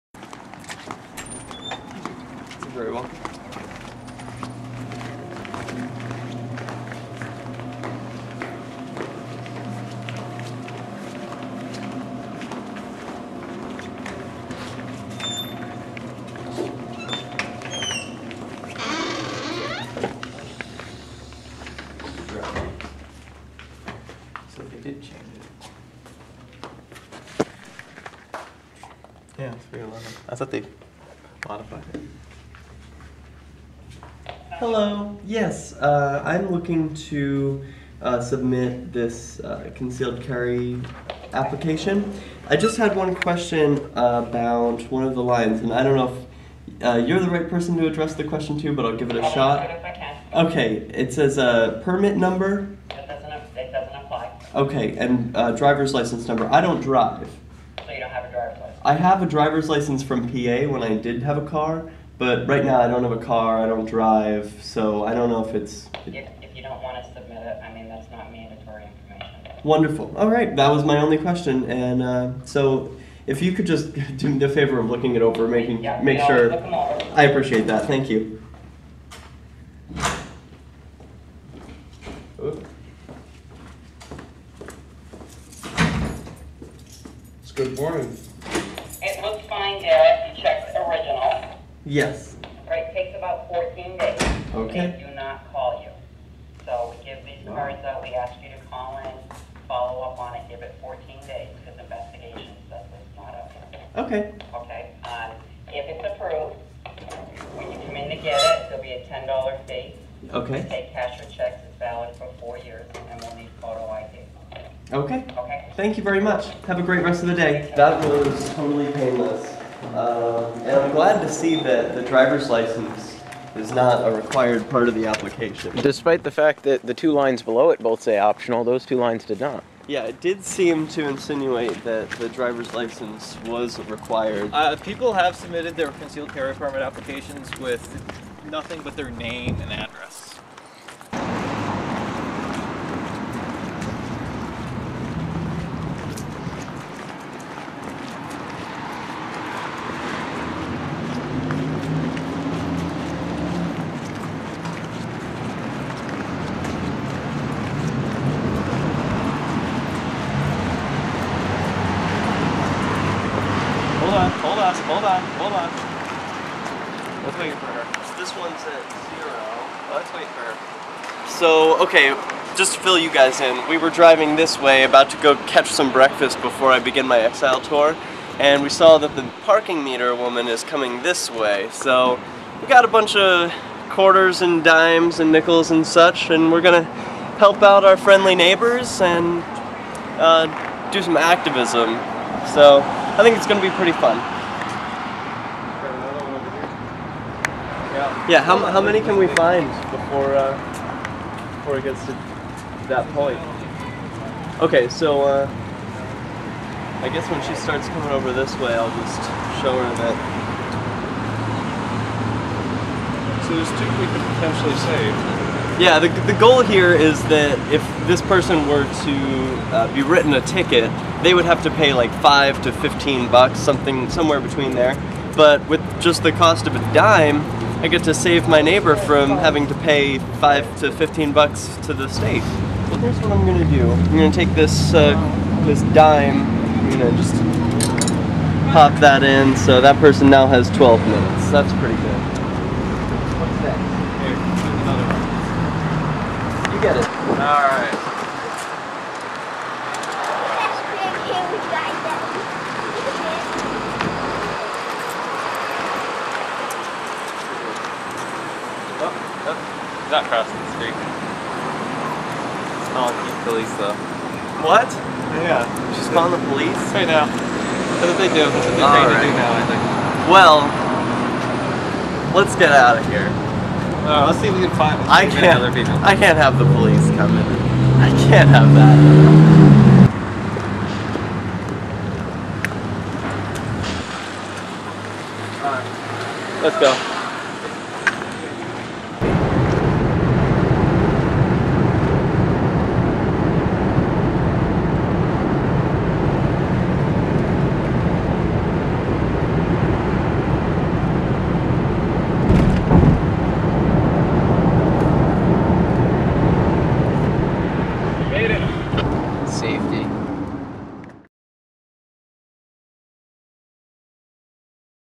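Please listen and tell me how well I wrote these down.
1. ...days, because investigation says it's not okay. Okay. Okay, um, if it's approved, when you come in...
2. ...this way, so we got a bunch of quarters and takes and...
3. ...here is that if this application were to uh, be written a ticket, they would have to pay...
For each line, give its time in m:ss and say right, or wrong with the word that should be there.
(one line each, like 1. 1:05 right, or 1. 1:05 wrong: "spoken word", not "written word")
1. 1:41 right
2. 3:01 wrong: "dimes", not "takes"
3. 3:36 wrong: "person", not "application".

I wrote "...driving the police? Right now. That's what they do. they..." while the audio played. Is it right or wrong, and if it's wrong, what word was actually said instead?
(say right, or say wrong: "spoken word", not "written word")
wrong: "calling", not "driving".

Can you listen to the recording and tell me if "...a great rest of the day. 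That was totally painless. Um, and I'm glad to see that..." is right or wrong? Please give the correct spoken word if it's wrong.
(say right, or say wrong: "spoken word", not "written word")
right.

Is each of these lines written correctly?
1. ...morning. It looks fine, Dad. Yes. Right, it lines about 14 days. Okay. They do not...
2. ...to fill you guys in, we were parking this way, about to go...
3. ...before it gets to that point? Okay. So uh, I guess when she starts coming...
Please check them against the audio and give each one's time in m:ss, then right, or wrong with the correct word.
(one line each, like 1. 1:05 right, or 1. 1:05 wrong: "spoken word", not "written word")
1. 1:27 wrong: "takes", not "lines"
2. 2:52 wrong: "driving", not "parking"
3. 3:21 right.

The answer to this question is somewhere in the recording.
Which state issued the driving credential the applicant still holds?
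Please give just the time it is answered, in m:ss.
1:00.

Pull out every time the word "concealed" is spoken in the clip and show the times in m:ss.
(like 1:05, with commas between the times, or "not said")
0:39, 2:15.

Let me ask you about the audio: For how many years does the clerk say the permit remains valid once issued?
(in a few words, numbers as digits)
4 years.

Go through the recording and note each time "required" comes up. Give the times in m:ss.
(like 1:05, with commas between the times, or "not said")
2:04, 2:13.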